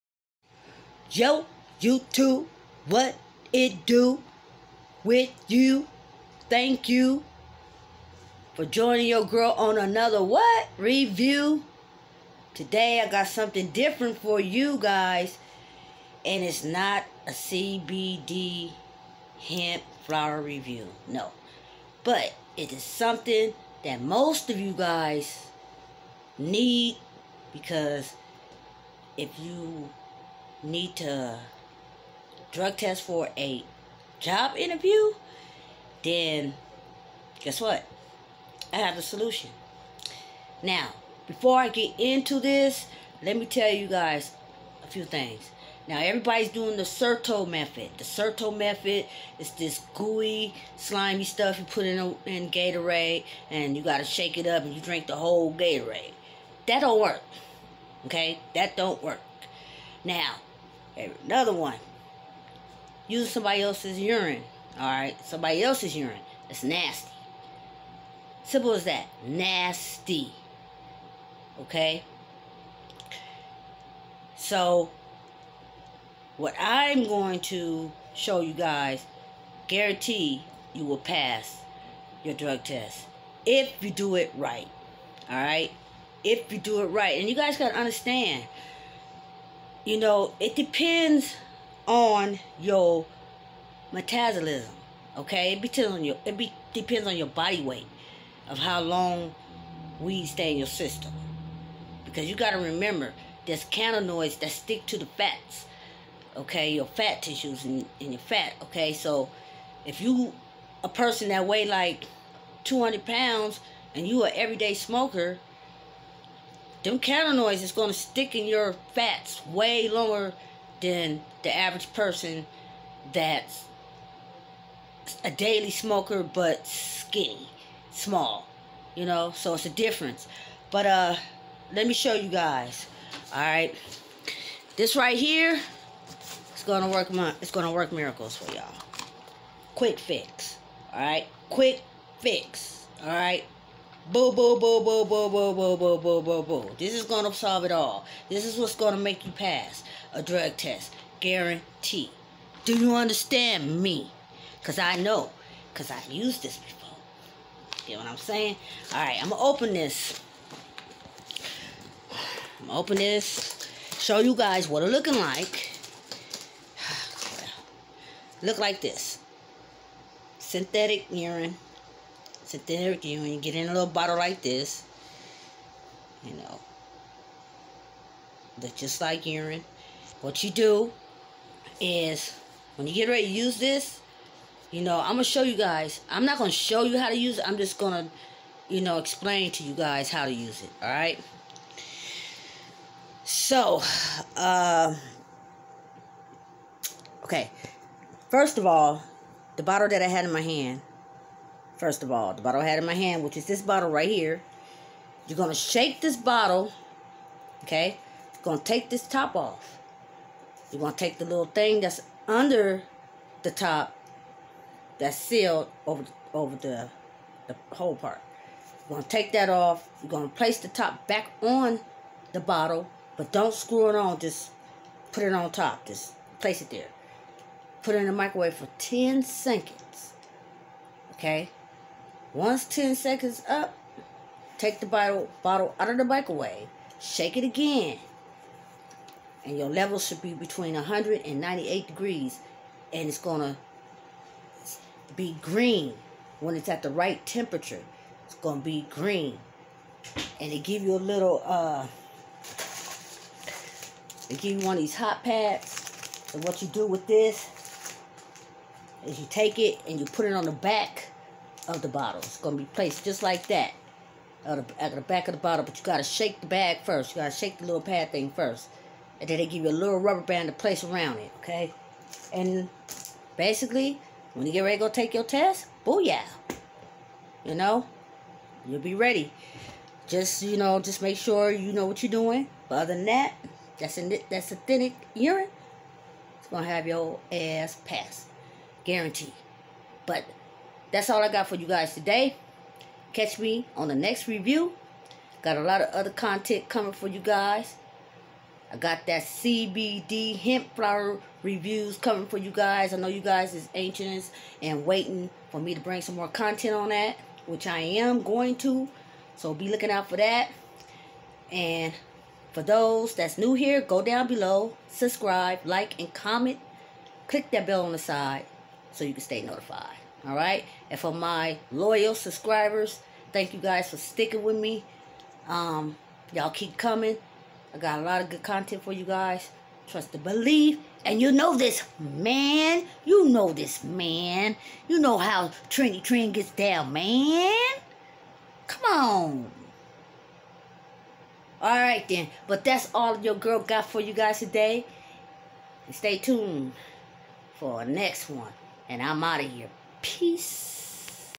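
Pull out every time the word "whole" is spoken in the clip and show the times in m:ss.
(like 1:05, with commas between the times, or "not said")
0:55, 3:37.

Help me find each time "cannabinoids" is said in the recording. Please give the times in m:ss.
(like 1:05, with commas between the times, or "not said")
1:43, 1:56.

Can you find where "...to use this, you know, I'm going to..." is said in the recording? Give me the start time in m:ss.
3:03.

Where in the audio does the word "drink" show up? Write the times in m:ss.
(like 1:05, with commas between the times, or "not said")
0:54.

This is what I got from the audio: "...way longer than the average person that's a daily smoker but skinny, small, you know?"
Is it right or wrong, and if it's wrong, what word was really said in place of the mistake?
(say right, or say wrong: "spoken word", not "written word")
right.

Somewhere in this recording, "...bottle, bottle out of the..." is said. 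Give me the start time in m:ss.
3:54.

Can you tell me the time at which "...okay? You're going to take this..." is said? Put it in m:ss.
3:27.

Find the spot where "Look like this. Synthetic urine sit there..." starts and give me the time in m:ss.
2:48.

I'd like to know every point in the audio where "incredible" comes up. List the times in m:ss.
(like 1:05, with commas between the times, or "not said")
not said.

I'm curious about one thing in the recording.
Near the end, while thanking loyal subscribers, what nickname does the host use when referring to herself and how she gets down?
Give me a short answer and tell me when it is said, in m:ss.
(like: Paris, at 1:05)
Trinity Trin, at 5:35.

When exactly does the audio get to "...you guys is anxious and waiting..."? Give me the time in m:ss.
5:03.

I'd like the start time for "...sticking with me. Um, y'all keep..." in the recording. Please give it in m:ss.
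5:23.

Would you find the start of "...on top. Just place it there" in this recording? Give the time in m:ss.
3:45.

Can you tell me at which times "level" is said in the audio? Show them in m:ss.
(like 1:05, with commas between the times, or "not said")
3:59.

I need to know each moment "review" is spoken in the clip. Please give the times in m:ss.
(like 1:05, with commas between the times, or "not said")
0:10, 0:20, 4:54, 5:01.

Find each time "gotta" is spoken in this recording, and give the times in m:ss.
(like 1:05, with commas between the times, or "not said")
1:42.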